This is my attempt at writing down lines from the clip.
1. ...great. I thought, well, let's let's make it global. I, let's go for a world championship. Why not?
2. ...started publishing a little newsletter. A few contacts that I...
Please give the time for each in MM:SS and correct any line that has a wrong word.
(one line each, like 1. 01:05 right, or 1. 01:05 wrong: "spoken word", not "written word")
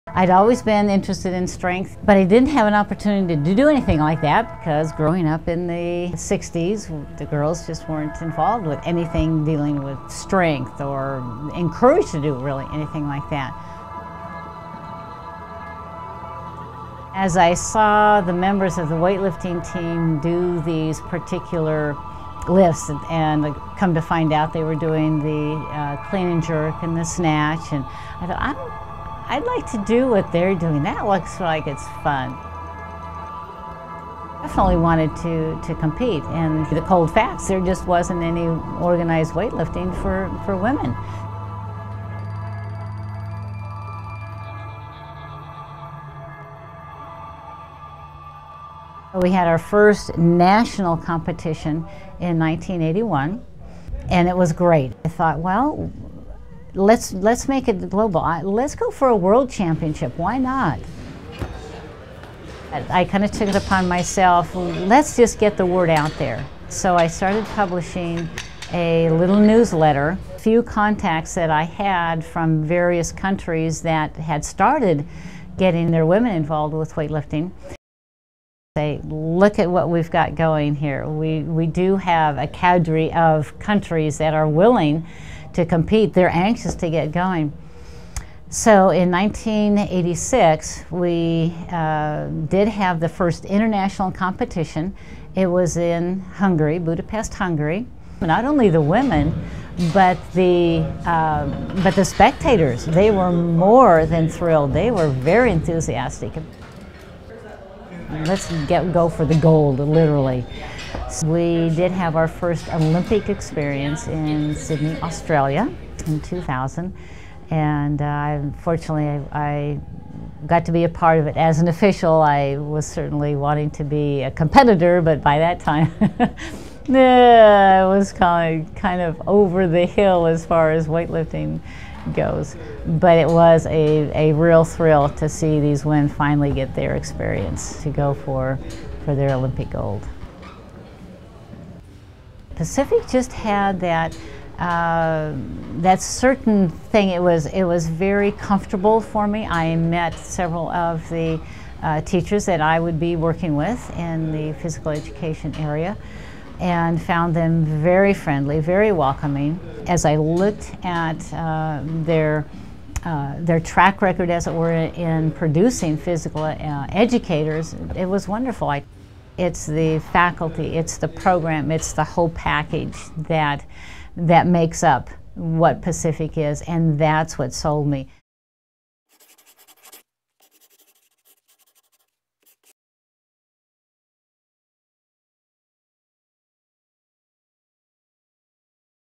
1. 00:54 right
2. 01:07 right.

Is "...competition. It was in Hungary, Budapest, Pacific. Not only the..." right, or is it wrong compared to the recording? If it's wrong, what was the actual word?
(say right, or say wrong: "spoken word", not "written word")
wrong: "Hungary", not "Pacific".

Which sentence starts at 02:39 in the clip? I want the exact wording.
As I looked at uh, their uh, their track record, as it were, in producing physical uh, educators, it was wonderful.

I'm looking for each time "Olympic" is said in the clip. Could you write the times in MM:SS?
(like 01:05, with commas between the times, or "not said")
01:52, 02:19.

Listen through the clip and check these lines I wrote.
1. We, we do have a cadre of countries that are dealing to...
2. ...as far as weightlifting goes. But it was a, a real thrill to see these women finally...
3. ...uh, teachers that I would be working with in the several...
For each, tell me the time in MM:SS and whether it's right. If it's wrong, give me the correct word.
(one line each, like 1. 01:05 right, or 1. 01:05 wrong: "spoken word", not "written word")
1. 01:21 wrong: "willing", not "dealing"
2. 02:10 right
3. 02:31 wrong: "physical", not "several".